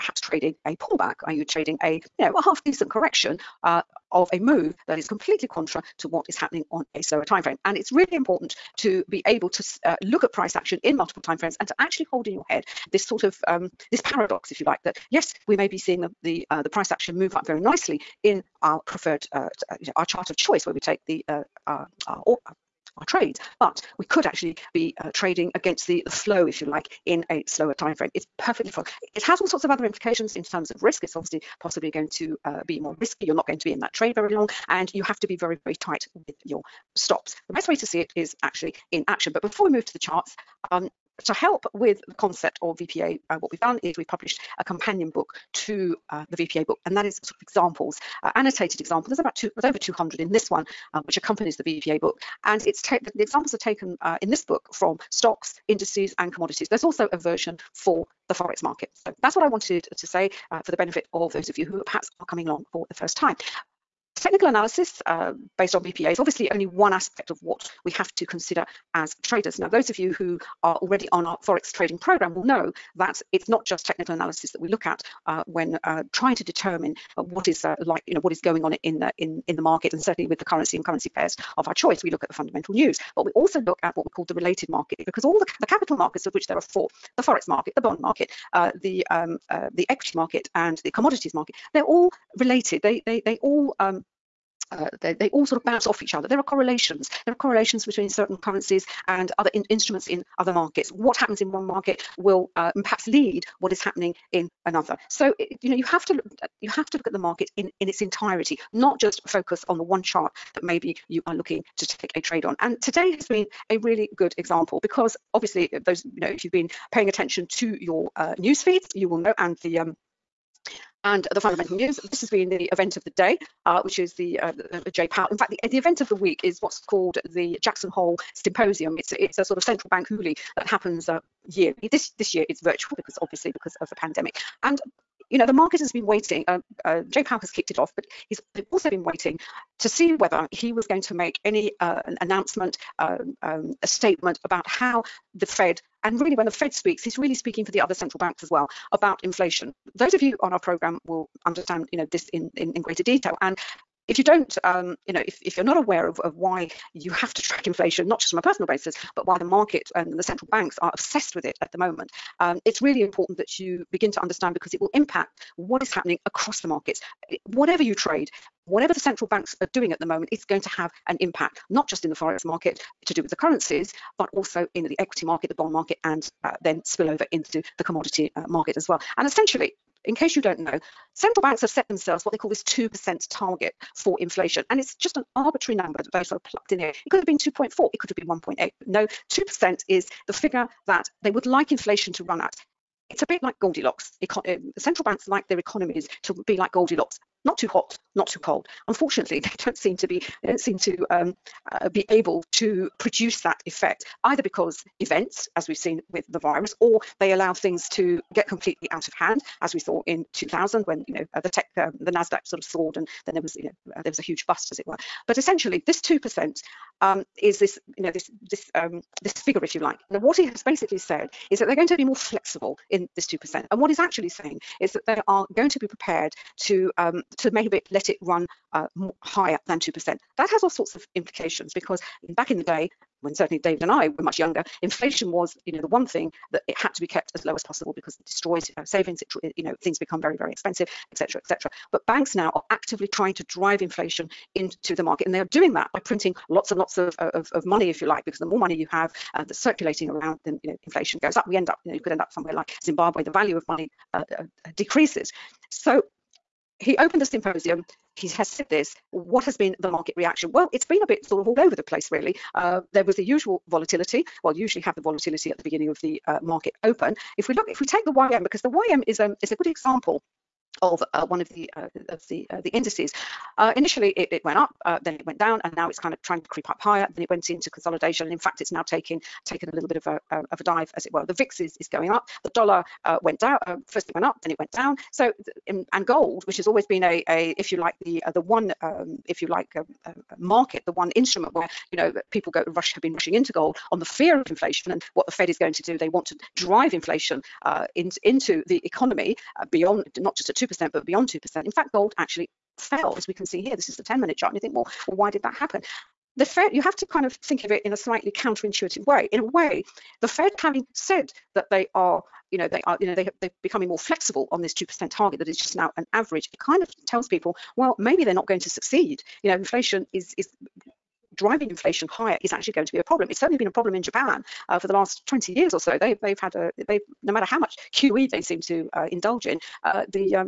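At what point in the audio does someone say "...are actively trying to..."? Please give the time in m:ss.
4:02.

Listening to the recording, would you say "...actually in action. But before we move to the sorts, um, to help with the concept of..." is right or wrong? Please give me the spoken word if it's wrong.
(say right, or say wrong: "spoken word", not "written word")
wrong: "charts", not "sorts".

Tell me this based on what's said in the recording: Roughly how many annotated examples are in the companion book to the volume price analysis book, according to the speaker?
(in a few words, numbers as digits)
over 200.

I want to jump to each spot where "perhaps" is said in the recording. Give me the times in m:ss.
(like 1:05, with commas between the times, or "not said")
1:01, 1:42.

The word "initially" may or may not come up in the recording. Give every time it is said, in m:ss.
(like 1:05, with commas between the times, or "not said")
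4:33.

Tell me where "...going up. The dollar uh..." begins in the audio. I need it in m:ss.
4:41.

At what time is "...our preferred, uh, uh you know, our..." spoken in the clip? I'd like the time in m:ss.
0:18.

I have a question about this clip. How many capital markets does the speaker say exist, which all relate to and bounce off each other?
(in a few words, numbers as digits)
4.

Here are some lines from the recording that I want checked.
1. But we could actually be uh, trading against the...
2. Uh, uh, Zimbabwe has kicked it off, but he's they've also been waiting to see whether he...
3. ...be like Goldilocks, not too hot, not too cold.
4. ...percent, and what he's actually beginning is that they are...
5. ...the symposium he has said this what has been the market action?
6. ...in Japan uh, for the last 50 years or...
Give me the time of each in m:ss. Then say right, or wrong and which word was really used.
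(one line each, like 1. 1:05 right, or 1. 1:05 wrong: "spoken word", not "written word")
1. 0:23 right
2. 2:16 wrong: "Powell", not "Zimbabwe"
3. 3:16 right
4. 3:43 wrong: "saying", not "beginning"
5. 4:17 wrong: "reaction", not "action"
6. 5:23 wrong: "20", not "50".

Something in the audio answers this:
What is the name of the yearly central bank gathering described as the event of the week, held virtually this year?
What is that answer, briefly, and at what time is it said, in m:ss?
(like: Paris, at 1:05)
Jackson Hole Symposium, at 2:07.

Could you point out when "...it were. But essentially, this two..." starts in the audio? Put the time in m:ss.
3:34.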